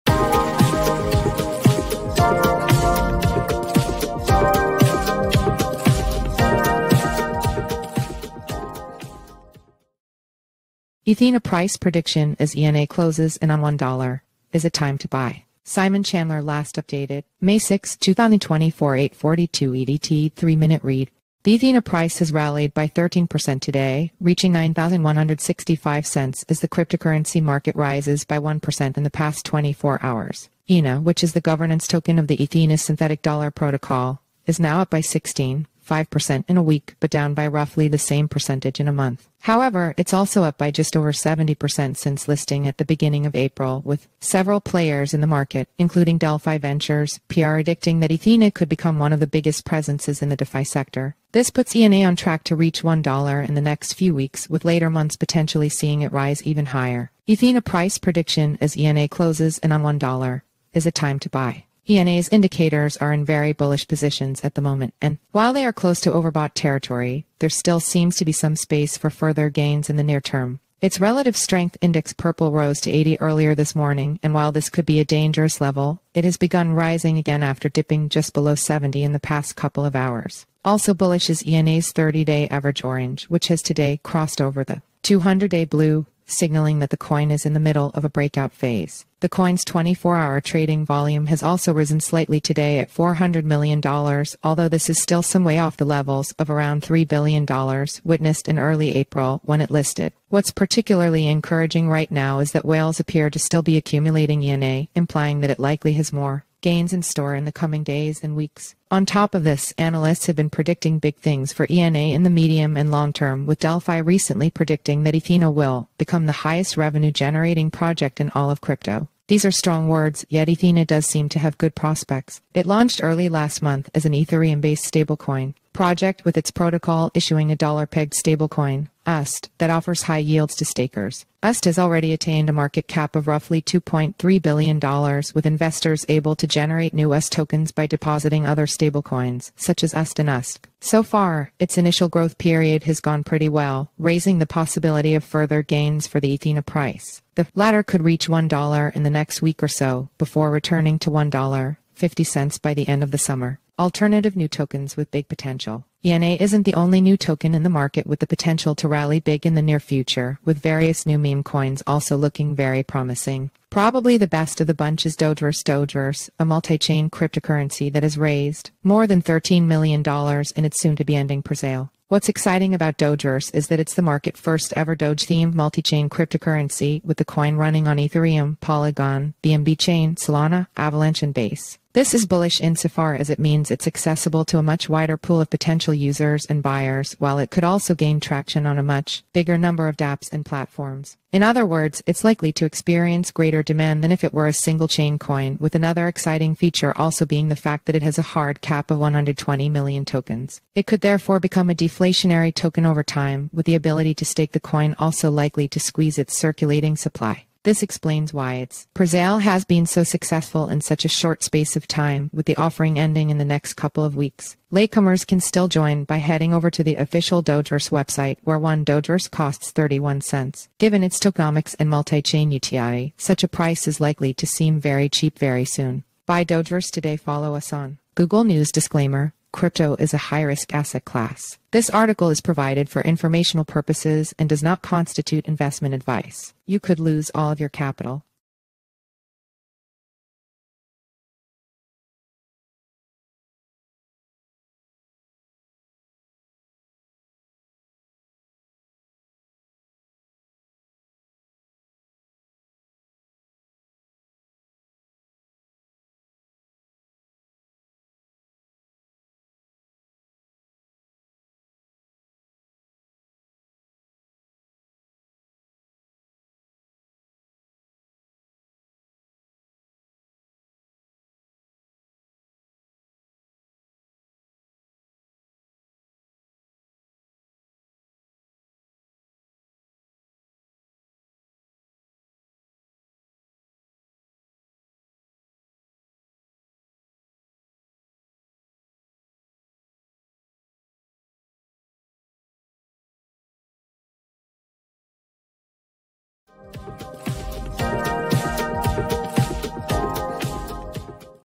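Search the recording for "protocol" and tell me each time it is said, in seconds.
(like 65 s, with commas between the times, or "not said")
33 s, 126 s.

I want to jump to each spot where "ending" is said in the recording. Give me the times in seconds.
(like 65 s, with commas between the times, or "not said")
171 s, 212 s.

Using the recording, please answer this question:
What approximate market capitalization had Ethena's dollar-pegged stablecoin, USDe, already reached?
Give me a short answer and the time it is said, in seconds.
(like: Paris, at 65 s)
$2.3 billion, at 133 s.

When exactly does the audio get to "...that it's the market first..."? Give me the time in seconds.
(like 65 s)
173 s.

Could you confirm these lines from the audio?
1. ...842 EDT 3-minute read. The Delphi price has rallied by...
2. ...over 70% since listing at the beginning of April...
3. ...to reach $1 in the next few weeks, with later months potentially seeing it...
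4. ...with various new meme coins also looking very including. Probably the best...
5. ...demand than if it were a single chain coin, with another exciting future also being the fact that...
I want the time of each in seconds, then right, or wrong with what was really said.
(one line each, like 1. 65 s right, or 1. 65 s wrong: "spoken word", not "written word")
1. 18 s wrong: "Ethena", not "Delphi"
2. 40 s right
3. 52 s right
4. 160 s wrong: "promising", not "including"
5. 193 s wrong: "feature", not "future".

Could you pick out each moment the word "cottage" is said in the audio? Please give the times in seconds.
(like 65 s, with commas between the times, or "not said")
not said.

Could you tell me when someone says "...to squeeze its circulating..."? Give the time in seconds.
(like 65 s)
205 s.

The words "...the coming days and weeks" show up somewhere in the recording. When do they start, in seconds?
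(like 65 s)
107 s.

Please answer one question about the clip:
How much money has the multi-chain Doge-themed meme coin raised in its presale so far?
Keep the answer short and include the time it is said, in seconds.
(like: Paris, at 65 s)
More than $13 million, at 169 s.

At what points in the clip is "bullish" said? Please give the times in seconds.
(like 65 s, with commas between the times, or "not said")
63 s, 80 s, 182 s.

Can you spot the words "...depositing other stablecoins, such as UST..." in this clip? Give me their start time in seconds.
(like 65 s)
137 s.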